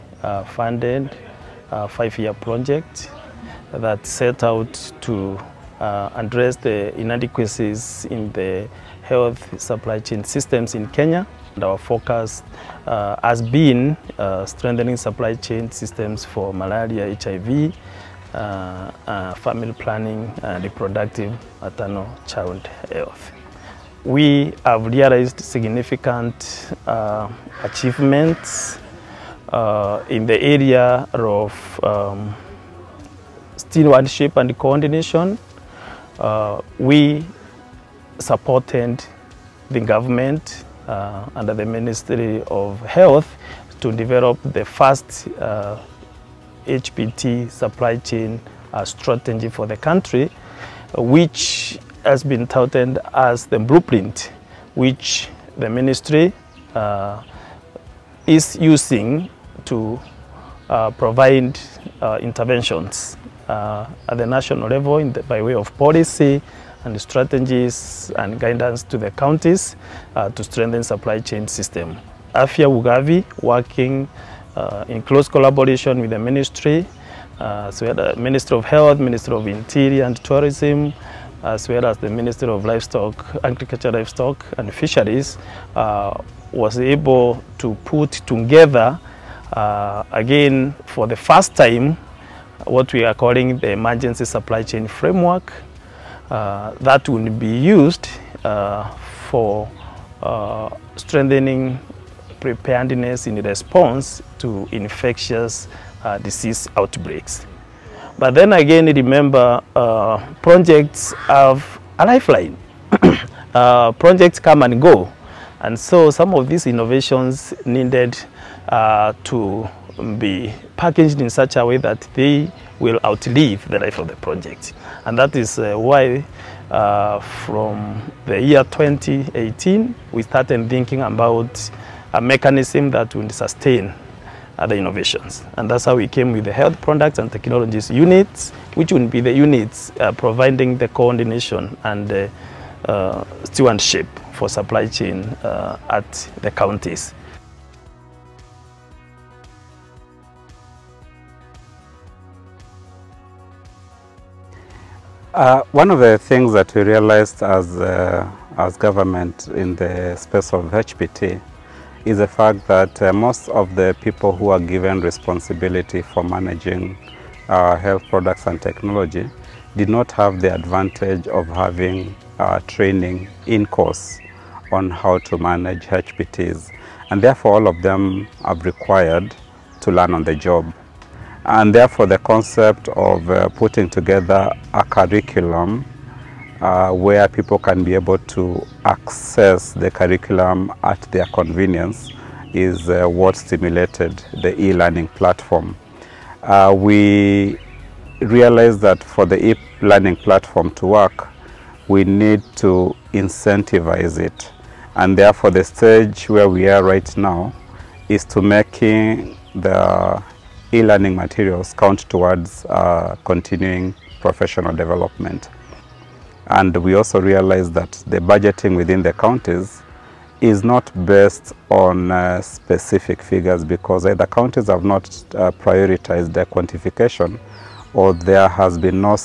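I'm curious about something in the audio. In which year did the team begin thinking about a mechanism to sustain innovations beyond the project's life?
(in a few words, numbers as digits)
2018.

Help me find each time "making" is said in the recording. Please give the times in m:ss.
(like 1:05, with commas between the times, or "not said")
3:28.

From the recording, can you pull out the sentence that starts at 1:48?
But then again, remember, uh, projects have a lifeline.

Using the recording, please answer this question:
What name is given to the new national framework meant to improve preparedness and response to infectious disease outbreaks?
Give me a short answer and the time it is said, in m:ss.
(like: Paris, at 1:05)
Emergency supply chain framework, at 1:33.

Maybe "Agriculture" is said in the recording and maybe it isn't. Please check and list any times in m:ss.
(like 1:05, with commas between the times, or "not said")
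1:23.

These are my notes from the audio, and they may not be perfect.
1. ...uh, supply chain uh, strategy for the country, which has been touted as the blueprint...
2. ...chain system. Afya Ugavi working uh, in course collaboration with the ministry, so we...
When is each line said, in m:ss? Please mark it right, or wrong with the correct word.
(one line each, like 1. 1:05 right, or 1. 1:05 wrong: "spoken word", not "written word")
1. 0:47 right
2. 1:11 wrong: "close", not "course".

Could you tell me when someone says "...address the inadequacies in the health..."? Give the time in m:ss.
0:06.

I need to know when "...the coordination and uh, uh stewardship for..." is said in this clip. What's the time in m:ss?
2:20.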